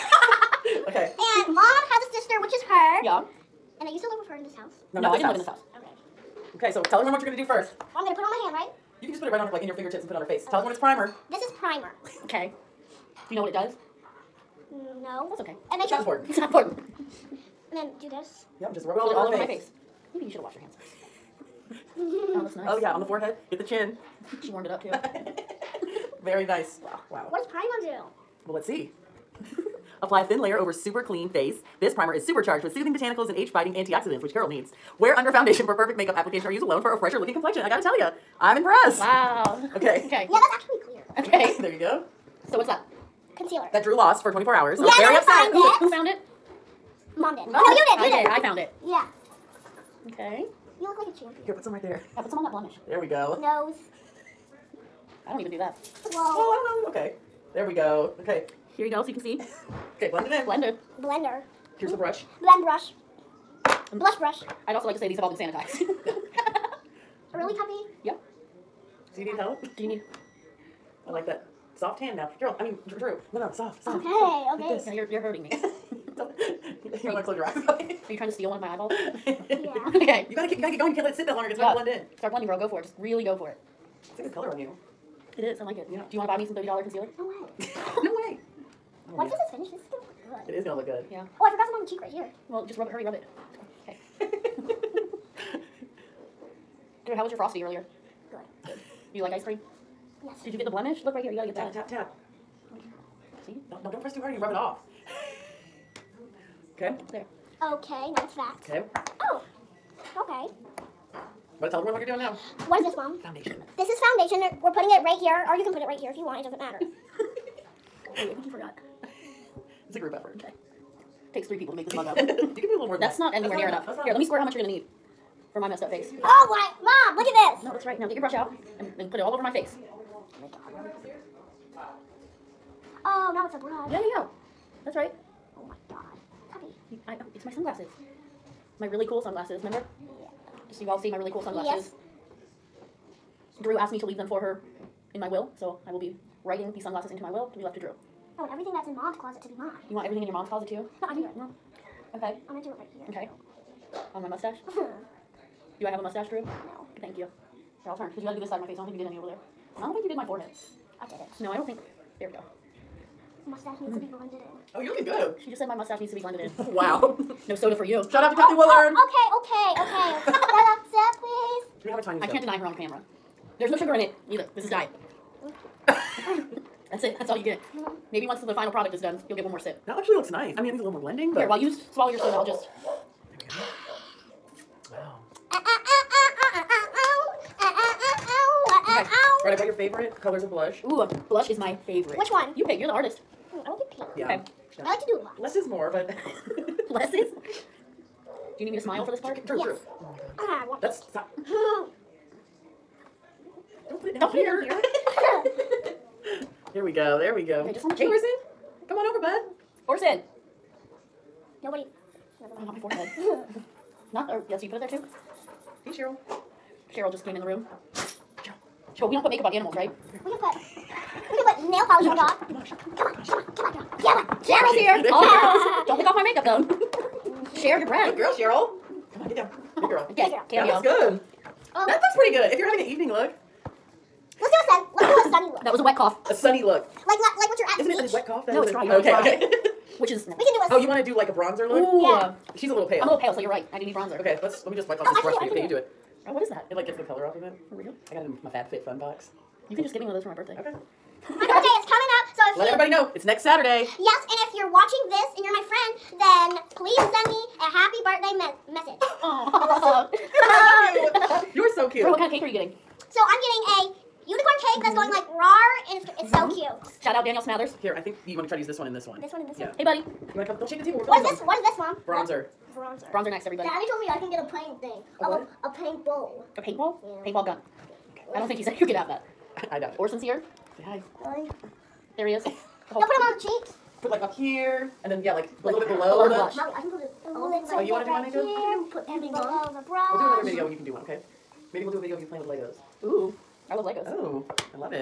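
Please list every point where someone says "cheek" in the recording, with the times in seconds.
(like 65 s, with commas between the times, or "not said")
91 s, 283 s.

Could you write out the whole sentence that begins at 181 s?
Here, while you swallow your soda, I'll just.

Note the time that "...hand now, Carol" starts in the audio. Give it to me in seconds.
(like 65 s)
71 s.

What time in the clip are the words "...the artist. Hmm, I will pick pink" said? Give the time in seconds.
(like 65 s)
192 s.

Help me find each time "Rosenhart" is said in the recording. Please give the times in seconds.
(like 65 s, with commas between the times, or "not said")
not said.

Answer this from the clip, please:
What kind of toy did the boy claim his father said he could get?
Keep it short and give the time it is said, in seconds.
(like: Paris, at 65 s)
Paintball gun, at 277 s.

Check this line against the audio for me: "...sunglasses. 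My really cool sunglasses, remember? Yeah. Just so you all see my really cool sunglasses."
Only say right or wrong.
right.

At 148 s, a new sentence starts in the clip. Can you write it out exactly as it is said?
I want everything that's in mom's closet to be mine.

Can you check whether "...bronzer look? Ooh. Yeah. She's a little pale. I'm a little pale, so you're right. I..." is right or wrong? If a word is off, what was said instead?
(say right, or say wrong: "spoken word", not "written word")
right.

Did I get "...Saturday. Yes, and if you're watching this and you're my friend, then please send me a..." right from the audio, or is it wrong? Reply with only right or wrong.
right.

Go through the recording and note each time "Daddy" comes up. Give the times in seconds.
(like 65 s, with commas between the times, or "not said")
273 s.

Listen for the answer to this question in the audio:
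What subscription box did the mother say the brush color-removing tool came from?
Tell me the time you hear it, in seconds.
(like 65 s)
248 s.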